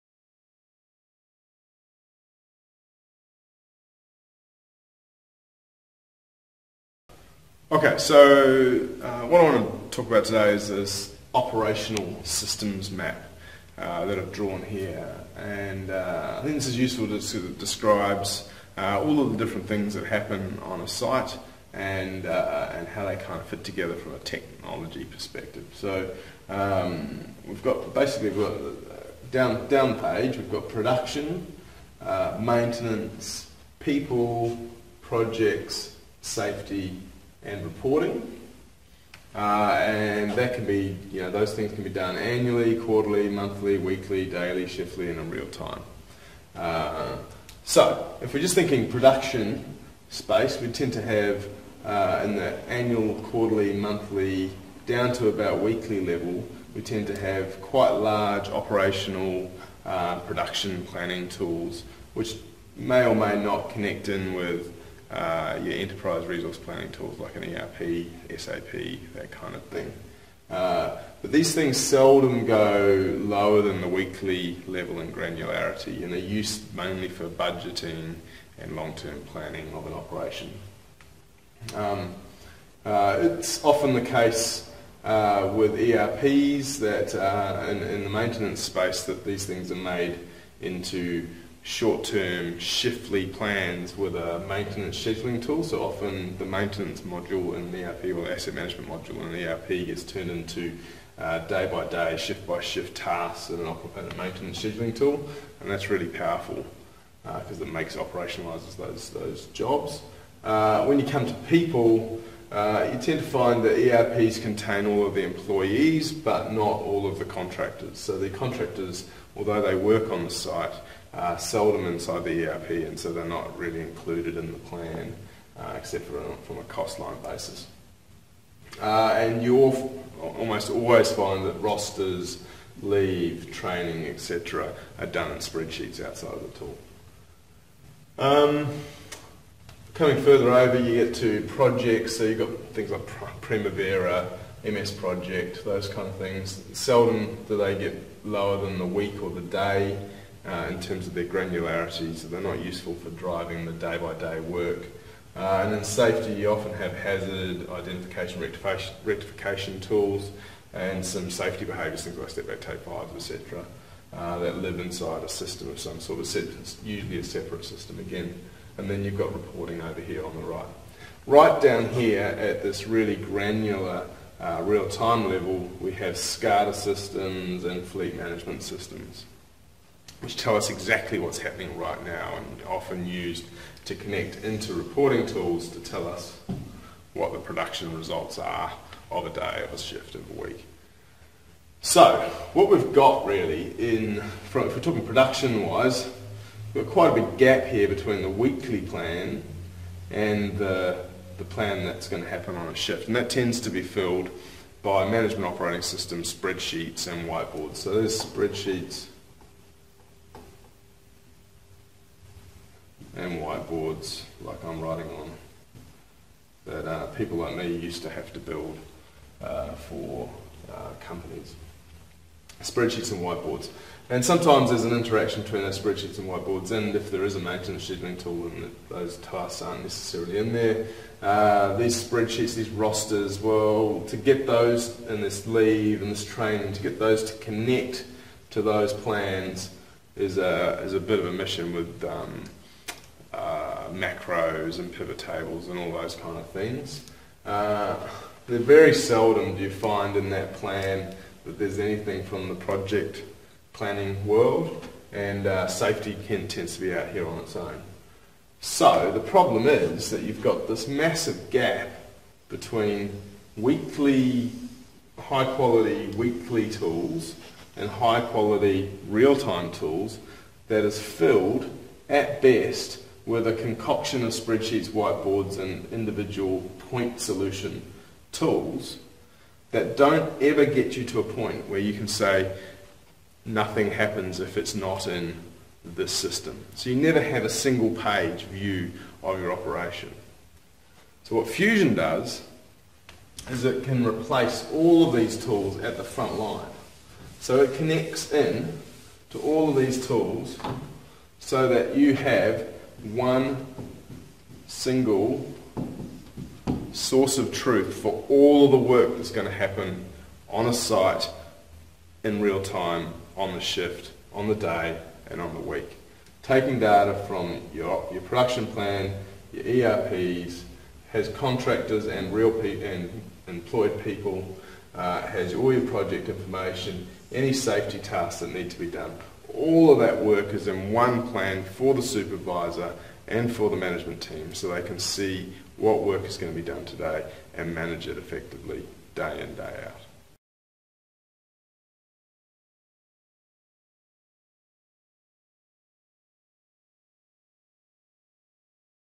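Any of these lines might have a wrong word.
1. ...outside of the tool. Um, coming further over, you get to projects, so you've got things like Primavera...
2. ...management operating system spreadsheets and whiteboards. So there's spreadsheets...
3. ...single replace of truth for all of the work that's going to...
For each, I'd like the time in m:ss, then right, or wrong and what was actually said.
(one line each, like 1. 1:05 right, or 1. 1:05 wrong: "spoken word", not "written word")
1. 2:16 right
2. 3:25 right
3. 5:04 wrong: "source", not "replace".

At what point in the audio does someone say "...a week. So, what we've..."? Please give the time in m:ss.
3:10.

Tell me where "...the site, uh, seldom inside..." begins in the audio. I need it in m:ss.
2:00.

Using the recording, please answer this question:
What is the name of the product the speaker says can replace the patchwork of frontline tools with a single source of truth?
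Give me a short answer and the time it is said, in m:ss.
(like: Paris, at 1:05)
Fewzion, at 4:51.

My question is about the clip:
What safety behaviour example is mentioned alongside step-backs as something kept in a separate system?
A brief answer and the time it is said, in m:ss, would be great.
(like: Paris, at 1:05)
take-fives, at 2:42.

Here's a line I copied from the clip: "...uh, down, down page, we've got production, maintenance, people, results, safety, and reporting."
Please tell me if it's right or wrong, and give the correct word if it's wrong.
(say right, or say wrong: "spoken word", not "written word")
wrong: "projects", not "results".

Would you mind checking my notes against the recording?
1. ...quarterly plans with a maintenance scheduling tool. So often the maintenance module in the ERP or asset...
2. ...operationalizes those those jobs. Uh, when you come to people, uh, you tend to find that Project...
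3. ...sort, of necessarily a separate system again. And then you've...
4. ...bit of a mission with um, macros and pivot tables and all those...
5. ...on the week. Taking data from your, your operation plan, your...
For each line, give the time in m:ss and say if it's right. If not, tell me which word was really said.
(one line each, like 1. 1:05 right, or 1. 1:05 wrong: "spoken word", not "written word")
1. 1:32 wrong: "shiftly", not "quarterly"
2. 1:47 wrong: "ERPs", not "Project"
3. 2:45 wrong: "usually", not "necessarily"
4. 4:00 right
5. 5:15 wrong: "production", not "operation".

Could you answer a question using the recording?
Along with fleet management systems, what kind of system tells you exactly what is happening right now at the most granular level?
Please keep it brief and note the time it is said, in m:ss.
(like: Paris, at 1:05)
SCADA systems, at 2:56.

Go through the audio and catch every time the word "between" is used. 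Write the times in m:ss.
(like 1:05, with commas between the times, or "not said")
3:17, 3:45, 4:22.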